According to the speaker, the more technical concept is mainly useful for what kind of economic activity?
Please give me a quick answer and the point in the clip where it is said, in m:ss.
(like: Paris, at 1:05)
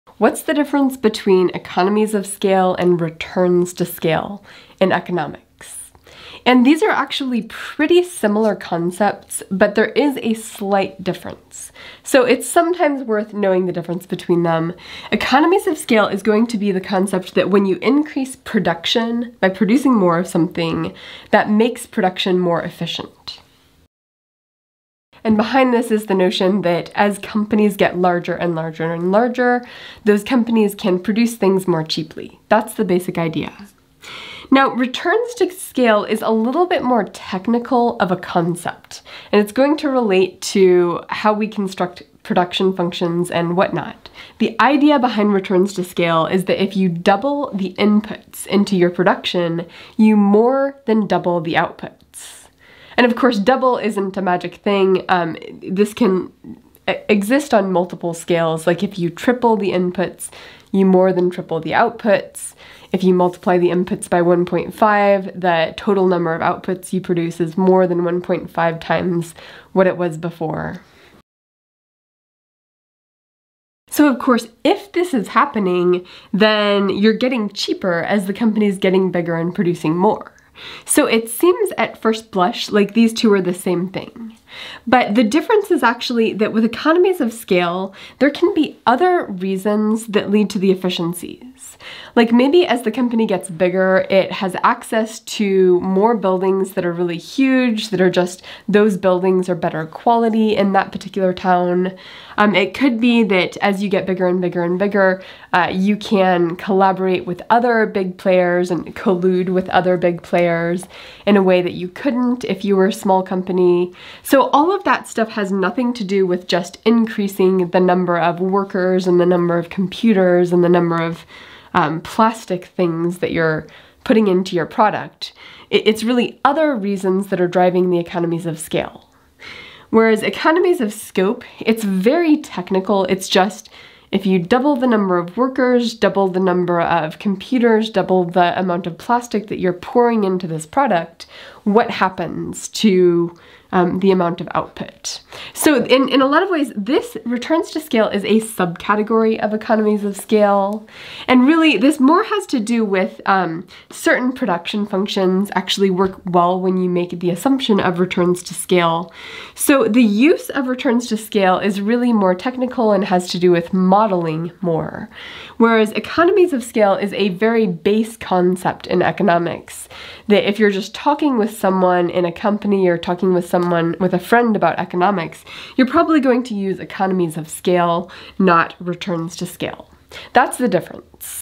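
Modeling, at 2:43.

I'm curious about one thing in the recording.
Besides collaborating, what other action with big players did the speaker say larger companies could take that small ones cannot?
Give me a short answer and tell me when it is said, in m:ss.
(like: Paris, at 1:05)
Collude, at 1:48.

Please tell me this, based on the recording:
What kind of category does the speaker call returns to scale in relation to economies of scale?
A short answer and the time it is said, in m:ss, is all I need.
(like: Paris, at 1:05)
Subcategory, at 2:28.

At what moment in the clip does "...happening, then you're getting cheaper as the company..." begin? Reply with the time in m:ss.
1:15.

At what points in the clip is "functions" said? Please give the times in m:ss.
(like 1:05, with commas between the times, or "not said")
0:42, 2:34.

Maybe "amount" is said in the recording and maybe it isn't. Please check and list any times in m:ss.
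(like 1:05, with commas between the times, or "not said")
2:18, 2:24.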